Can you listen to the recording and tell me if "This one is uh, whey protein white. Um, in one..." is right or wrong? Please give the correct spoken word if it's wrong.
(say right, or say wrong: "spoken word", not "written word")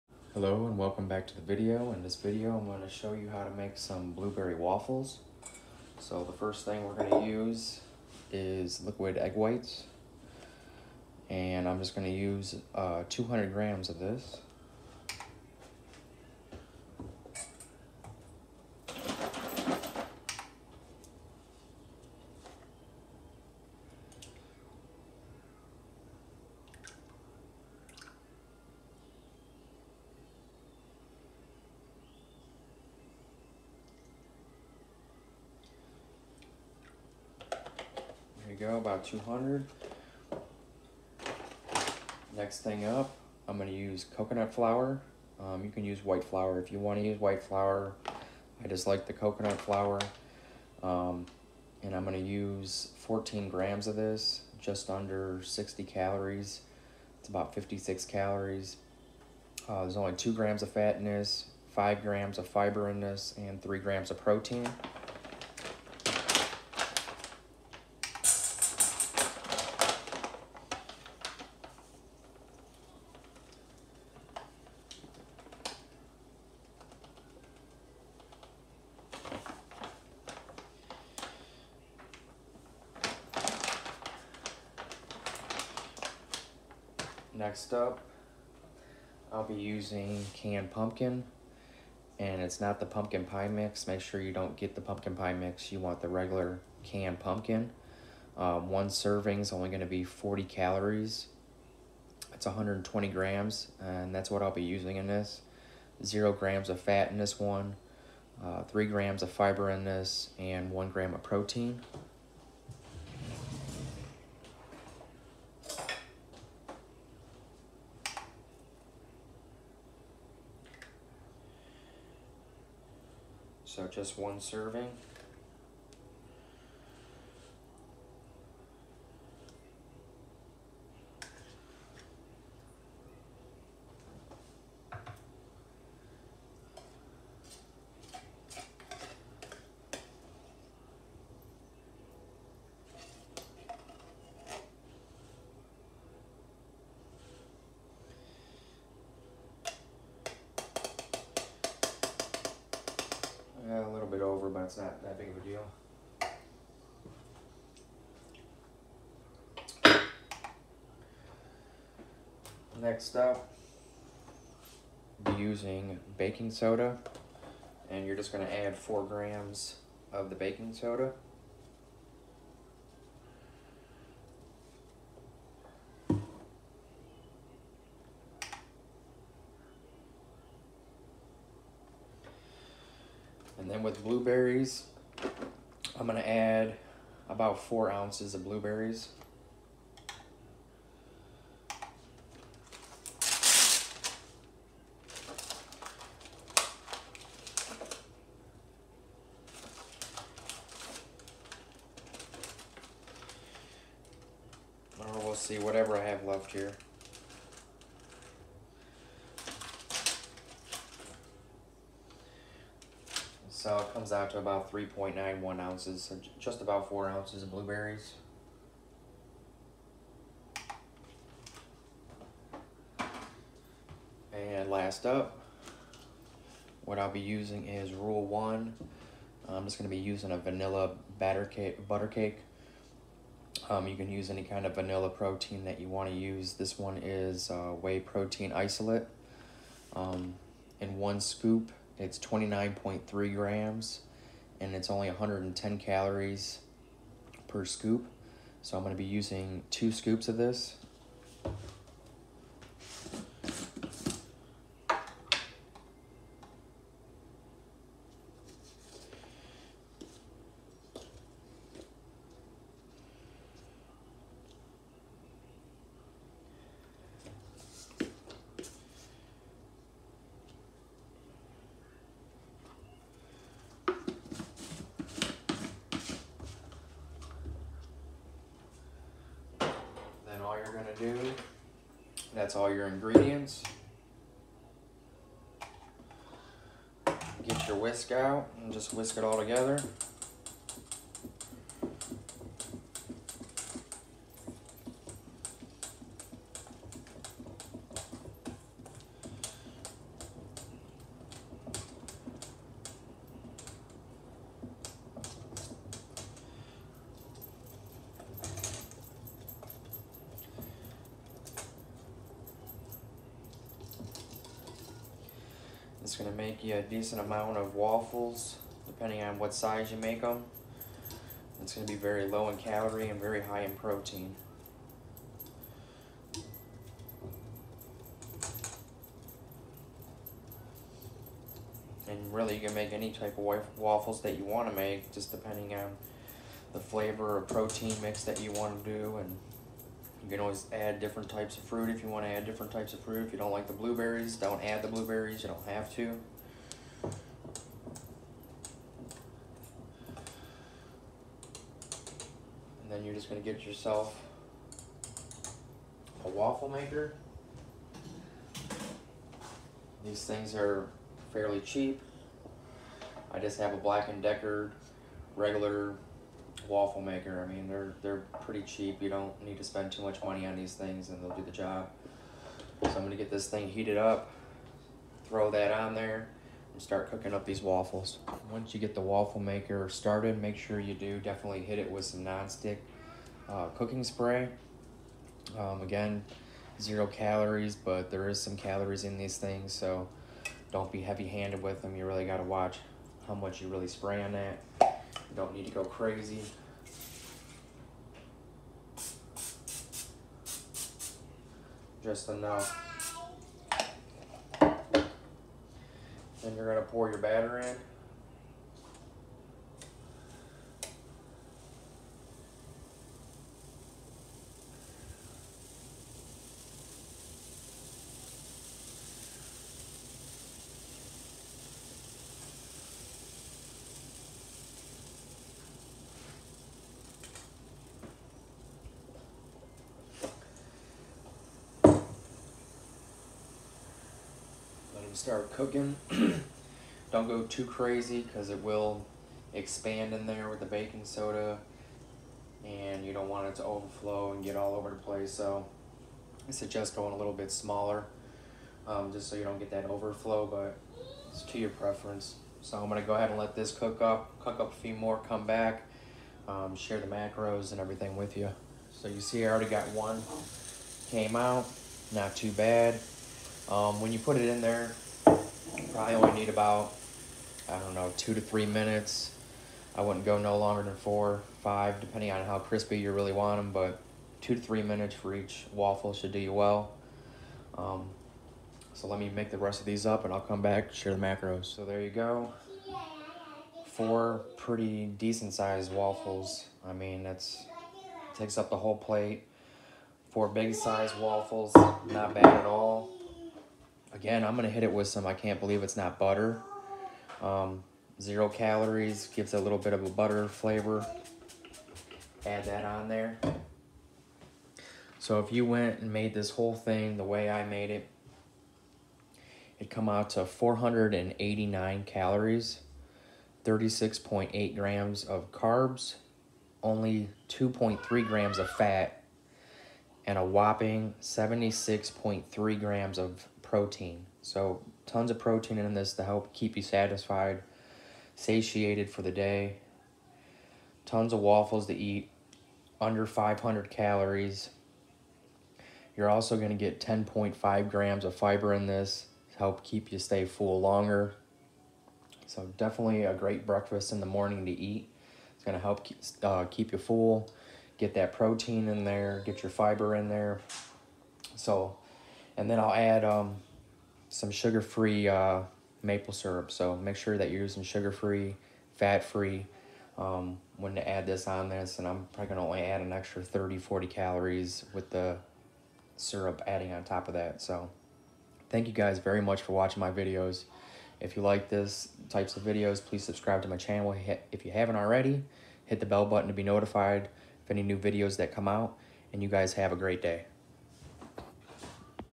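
wrong: "isolate", not "white".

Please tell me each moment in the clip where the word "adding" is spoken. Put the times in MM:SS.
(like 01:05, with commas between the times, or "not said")
09:26.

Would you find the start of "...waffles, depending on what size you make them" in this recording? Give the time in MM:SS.
05:17.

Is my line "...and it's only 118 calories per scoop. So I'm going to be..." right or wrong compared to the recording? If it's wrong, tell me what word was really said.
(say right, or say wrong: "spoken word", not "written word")
wrong: "110", not "118".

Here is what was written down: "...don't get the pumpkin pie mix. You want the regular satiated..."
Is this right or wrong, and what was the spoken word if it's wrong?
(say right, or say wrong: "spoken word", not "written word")
wrong: "canned", not "satiated".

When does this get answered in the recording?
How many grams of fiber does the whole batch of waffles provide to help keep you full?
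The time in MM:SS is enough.
08:56.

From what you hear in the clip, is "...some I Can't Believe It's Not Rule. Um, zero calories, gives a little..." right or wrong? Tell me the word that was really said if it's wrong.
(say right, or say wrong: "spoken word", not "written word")
wrong: "Butter", not "Rule".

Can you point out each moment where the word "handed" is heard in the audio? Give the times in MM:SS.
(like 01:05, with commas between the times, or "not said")
06:31.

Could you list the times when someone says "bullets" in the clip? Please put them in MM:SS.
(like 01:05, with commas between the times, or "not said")
not said.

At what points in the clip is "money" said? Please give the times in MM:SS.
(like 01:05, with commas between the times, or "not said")
06:10.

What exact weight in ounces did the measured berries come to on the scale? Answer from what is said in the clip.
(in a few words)
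3.91 ounces.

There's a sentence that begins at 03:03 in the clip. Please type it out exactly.
And then with blueberries, I'm gonna add about four ounces of blueberries.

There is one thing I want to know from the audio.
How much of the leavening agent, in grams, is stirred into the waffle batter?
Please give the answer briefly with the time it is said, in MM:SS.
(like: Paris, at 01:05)
4 grams, at 02:48.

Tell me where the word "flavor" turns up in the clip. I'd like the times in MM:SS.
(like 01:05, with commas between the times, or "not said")
05:36, 08:20.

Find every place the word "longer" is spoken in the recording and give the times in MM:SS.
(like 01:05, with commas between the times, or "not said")
07:50, 09:00.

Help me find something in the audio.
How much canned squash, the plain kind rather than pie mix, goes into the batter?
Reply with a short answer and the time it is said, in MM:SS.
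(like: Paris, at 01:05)
120 grams, at 01:42.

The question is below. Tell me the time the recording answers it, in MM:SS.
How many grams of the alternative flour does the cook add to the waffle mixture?
00:52.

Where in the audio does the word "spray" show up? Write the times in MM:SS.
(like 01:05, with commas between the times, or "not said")
06:24, 06:33.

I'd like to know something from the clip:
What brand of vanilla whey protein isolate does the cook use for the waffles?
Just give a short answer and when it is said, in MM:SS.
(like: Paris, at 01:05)
Rule 1, at 03:47.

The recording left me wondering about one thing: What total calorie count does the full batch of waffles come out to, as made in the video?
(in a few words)
489.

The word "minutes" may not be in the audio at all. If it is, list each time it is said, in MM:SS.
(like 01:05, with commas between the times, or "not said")
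07:48, 07:54.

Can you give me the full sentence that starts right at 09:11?
So and then I'll add um, some sugar-free uh, maple syrup.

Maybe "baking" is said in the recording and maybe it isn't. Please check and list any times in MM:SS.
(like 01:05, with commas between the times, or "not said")
02:46, 02:50, 07:20.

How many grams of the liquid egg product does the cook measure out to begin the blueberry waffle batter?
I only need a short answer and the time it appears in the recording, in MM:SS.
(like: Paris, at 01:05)
200, at 00:13.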